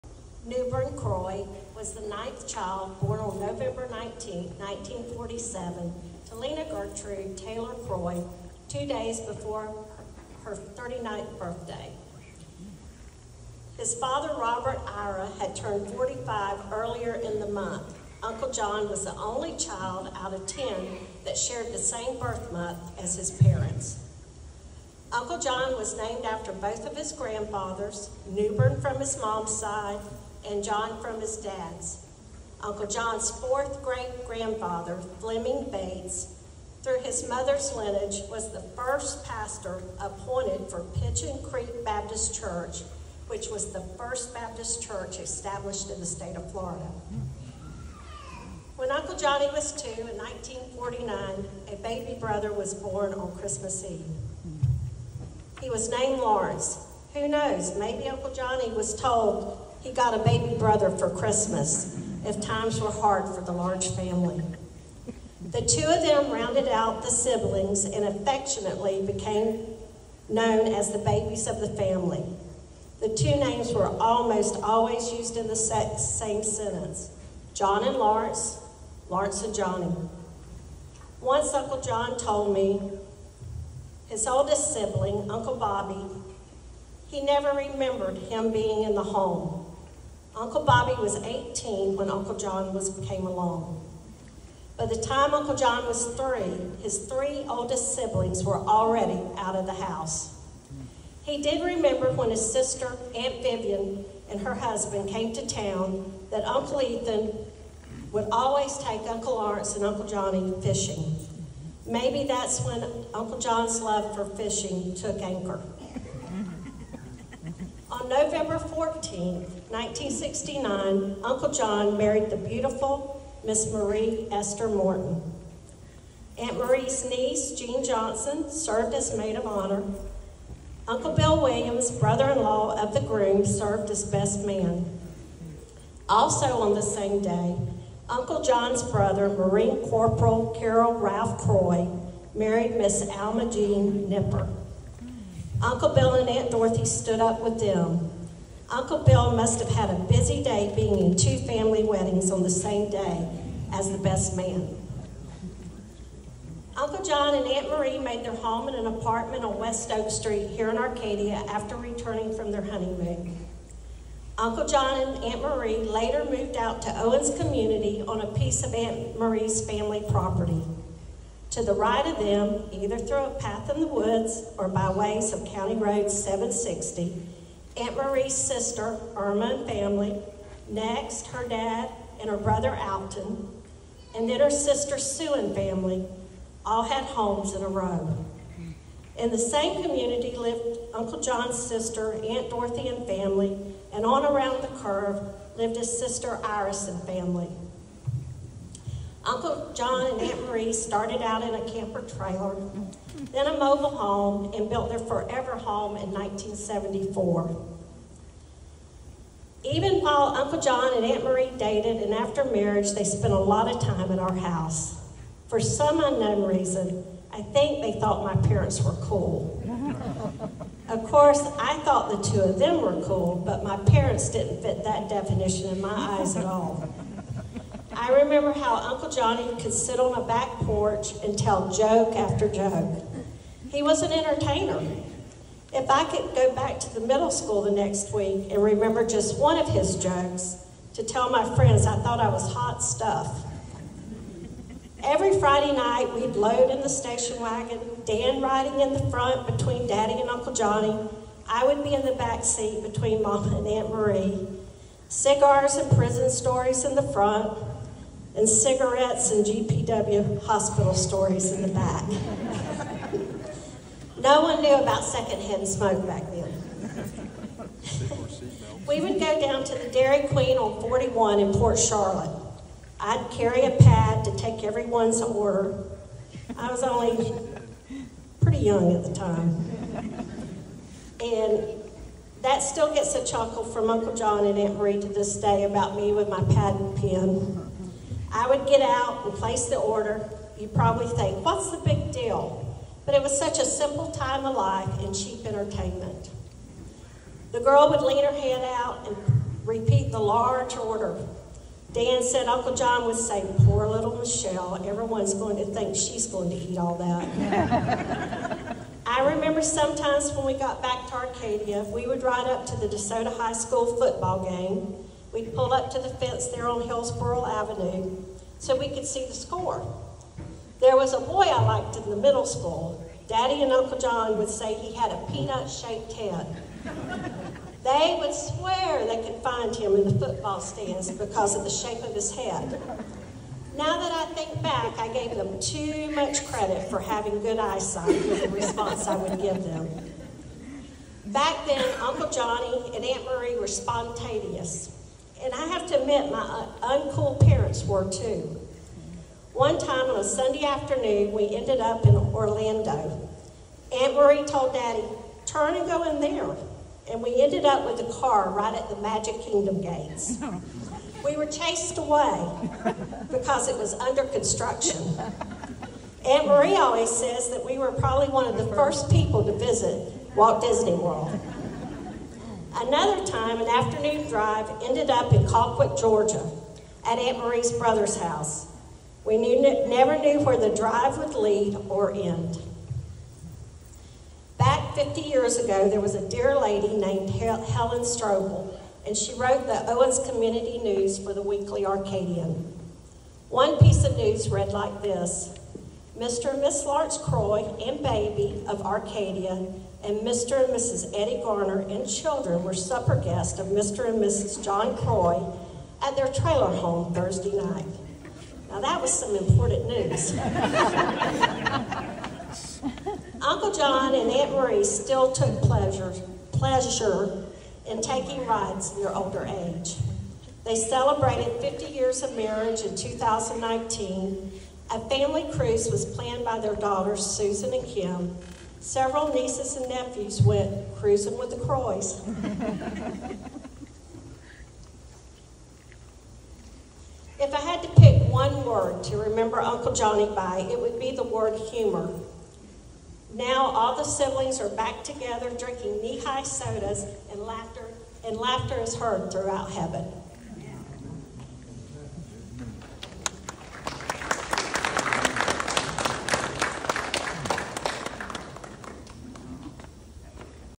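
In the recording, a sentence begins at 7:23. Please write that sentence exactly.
Now all the siblings are back together drinking knee-high sodas and laughter, and laughter is heard throughout heaven.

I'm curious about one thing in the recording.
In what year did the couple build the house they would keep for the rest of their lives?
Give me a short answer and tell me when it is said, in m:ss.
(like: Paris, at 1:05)
1974, at 3:26.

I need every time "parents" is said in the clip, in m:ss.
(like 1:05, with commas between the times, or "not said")
0:23, 3:38, 3:43, 5:47.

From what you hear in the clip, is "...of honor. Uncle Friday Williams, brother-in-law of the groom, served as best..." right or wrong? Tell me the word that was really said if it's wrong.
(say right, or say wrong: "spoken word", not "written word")
wrong: "Bill", not "Friday".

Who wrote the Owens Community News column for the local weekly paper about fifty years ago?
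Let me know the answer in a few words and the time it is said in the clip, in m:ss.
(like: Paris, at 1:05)
Helen Strobel, at 6:27.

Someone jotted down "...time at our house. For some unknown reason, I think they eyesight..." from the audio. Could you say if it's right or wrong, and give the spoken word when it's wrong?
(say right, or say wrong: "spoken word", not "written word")
wrong: "thought", not "eyesight".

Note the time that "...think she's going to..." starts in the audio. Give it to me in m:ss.
5:05.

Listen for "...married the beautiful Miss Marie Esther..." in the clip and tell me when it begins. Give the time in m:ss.
2:01.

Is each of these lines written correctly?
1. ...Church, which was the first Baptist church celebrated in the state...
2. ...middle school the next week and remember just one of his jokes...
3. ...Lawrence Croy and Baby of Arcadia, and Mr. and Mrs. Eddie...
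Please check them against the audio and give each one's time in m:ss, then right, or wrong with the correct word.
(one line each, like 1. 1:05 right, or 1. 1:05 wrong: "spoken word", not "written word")
1. 0:42 wrong: "established", not "celebrated"
2. 3:57 right
3. 6:36 right.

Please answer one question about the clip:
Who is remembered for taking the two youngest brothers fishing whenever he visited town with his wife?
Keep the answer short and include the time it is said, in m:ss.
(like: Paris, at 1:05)
Uncle Ethan, at 1:46.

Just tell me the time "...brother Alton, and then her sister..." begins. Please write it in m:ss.
3:02.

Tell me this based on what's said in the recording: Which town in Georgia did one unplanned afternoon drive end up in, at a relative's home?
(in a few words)
Colquitt.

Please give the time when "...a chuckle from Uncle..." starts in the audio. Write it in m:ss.
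4:43.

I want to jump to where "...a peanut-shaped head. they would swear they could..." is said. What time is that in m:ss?
5:25.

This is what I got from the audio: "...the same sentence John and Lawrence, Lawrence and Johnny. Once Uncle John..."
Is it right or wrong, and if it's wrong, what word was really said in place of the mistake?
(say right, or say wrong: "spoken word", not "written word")
right.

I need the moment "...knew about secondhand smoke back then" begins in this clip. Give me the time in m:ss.
4:24.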